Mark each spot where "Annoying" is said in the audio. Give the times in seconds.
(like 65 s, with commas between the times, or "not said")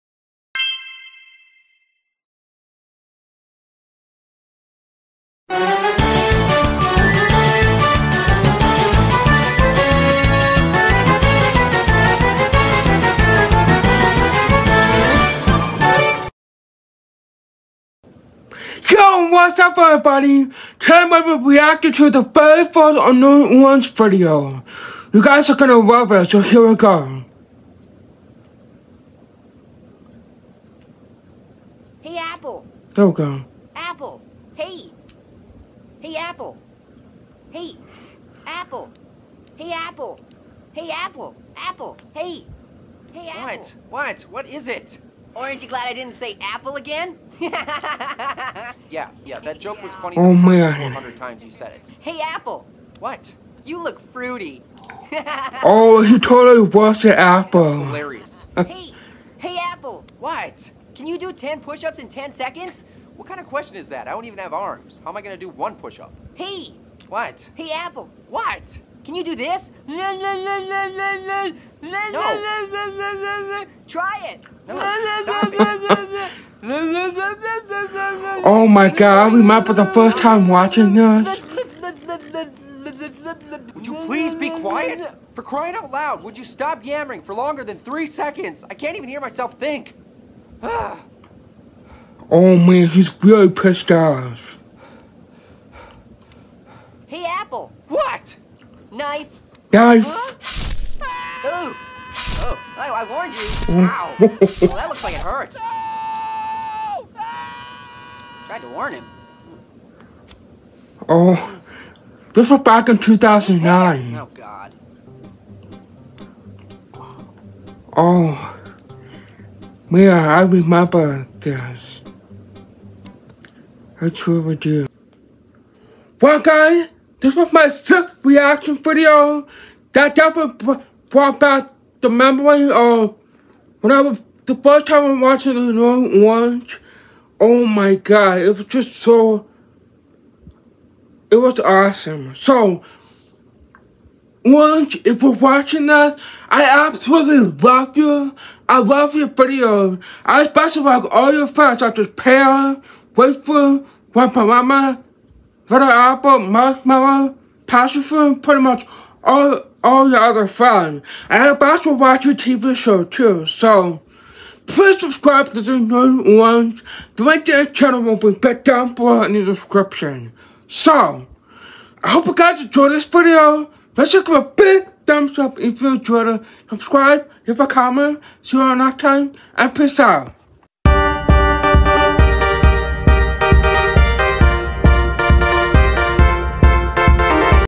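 22 s, 135 s, 165 s.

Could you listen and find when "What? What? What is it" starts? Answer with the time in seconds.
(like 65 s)
43 s.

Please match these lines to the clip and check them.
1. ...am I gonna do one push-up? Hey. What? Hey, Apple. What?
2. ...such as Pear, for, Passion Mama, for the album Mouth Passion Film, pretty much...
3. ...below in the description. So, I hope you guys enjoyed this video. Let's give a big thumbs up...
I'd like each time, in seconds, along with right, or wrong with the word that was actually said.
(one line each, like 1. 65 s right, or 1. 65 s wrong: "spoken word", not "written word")
1. 65 s right
2. 151 s wrong: "Grandpa", not "Passion"
3. 168 s right.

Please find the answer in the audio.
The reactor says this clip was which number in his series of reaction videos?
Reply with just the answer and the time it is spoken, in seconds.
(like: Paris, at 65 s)
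sixth, at 127 s.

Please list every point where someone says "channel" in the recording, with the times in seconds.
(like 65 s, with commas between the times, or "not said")
167 s.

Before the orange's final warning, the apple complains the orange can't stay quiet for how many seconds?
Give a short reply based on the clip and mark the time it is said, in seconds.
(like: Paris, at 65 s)
3, at 87 s.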